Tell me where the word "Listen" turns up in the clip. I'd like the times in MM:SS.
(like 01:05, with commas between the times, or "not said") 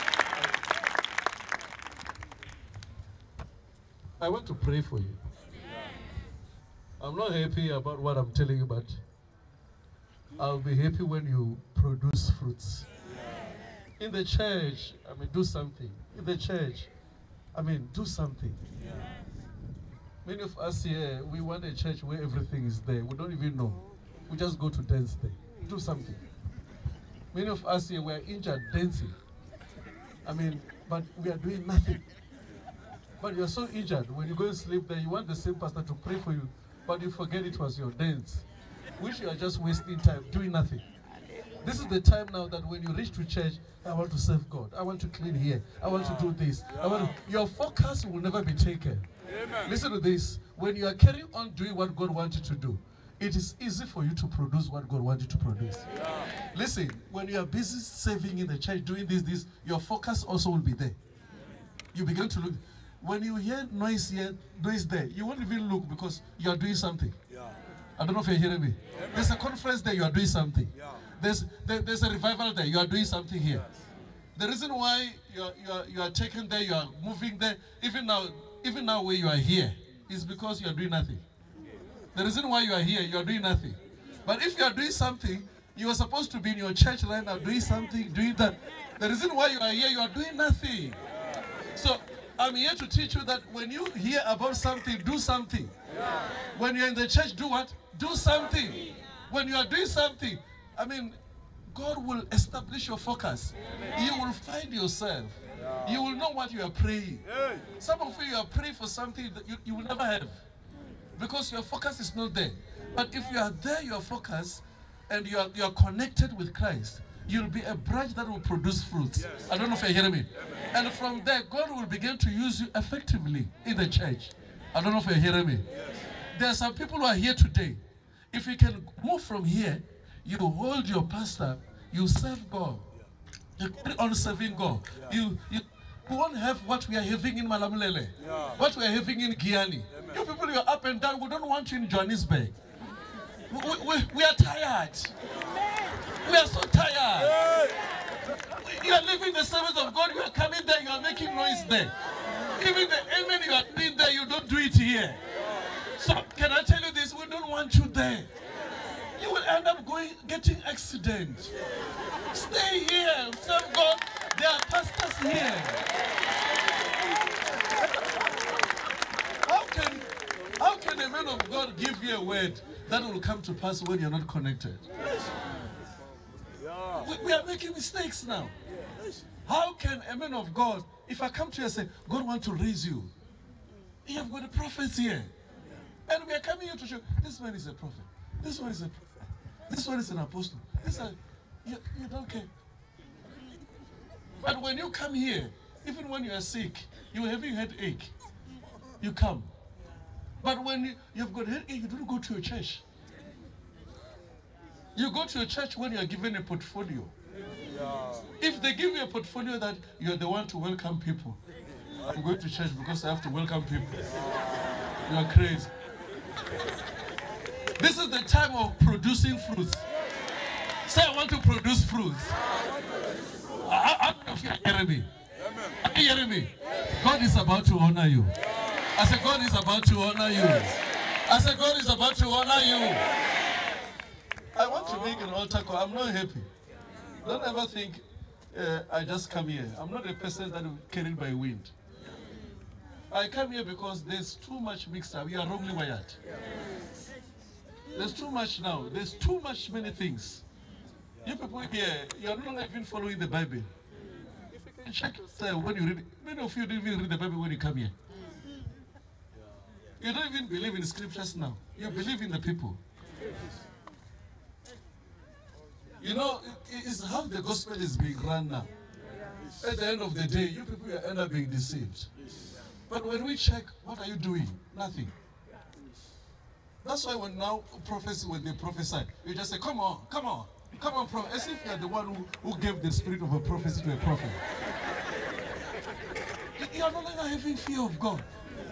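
00:49, 00:56.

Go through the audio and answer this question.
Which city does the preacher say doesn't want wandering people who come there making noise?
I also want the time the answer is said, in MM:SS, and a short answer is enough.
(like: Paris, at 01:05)
Johannesburg, at 02:21.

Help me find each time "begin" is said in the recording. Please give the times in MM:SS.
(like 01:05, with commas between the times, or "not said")
01:02, 02:01.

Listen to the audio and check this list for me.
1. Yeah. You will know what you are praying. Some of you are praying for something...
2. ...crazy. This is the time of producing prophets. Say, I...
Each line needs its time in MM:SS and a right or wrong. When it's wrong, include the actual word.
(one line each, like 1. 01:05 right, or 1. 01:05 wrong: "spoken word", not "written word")
1. 01:45 right
2. 03:35 wrong: "fruits", not "prophets".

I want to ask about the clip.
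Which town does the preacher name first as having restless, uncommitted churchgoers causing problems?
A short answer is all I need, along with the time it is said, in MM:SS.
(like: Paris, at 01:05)
Malamulele, at 02:17.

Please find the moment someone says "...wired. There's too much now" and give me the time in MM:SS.
04:05.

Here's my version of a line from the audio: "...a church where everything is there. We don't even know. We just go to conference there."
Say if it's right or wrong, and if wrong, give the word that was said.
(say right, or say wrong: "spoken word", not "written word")
wrong: "dance", not "conference".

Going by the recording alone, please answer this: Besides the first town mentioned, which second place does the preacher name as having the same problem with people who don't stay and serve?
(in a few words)
Giyani.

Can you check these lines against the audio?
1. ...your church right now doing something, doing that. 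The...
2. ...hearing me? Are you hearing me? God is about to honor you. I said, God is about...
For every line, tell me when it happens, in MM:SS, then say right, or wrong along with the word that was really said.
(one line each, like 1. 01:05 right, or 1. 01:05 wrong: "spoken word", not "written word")
1. 01:26 right
2. 03:44 right.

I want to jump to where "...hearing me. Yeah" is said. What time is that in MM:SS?
01:08.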